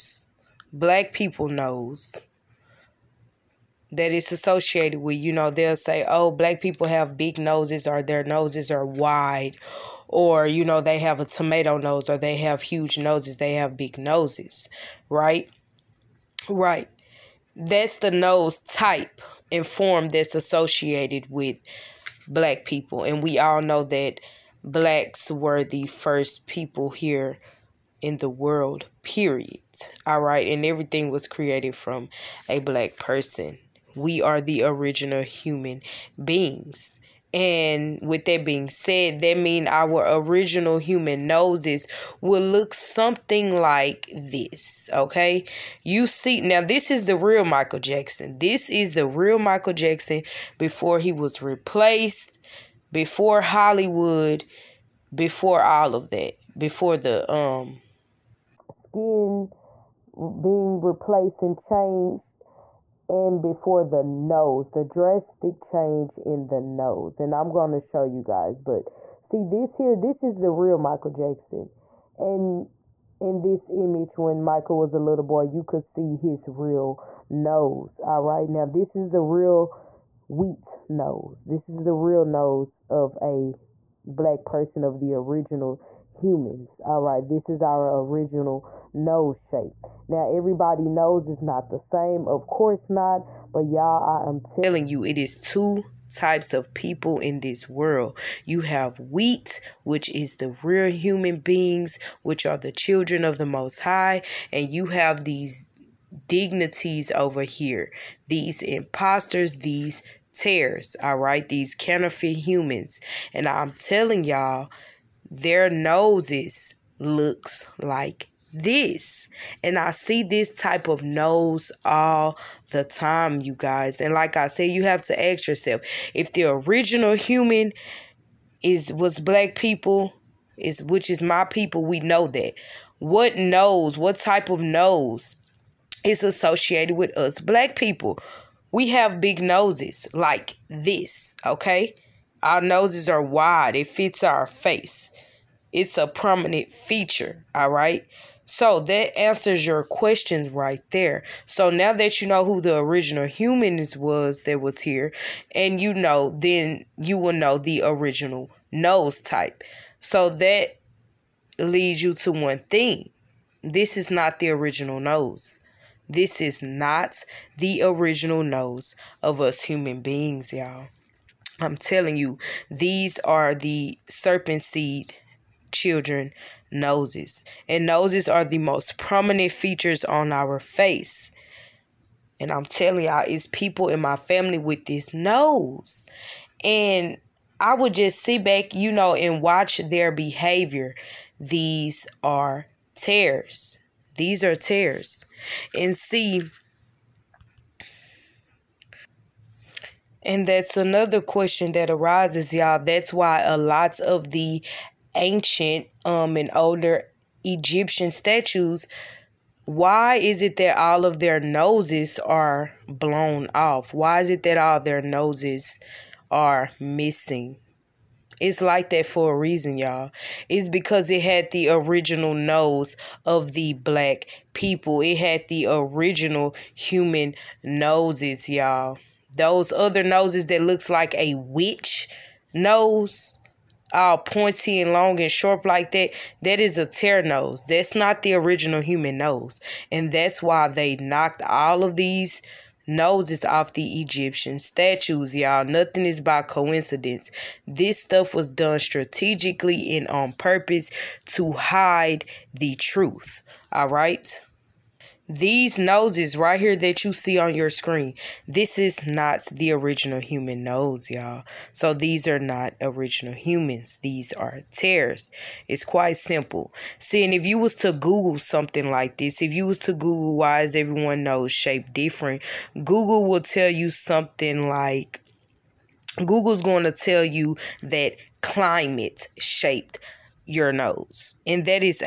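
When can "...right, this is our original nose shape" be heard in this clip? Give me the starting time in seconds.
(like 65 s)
87 s.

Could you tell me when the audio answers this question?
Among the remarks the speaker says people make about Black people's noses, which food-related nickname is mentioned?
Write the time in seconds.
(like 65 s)
11 s.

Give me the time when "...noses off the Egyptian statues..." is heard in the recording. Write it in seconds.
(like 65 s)
242 s.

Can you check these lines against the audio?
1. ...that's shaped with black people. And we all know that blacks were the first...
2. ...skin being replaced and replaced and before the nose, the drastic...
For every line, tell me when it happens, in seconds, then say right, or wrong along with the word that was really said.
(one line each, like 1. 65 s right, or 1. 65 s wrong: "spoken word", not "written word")
1. 20 s wrong: "associated", not "shaped"
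2. 58 s wrong: "changed", not "replaced".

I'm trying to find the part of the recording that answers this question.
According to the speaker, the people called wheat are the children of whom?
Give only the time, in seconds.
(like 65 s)
103 s.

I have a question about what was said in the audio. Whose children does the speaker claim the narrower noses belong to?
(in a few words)
serpent seed.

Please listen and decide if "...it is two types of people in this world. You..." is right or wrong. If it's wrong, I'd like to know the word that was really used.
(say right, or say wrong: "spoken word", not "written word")
right.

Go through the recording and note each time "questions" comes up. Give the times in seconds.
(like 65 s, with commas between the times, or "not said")
149 s, 201 s.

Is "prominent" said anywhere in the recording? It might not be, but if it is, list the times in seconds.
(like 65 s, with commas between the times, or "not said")
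146 s, 178 s.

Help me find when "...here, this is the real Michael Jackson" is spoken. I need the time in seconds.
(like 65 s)
69 s.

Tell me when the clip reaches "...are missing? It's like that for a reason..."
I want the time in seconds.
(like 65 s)
216 s.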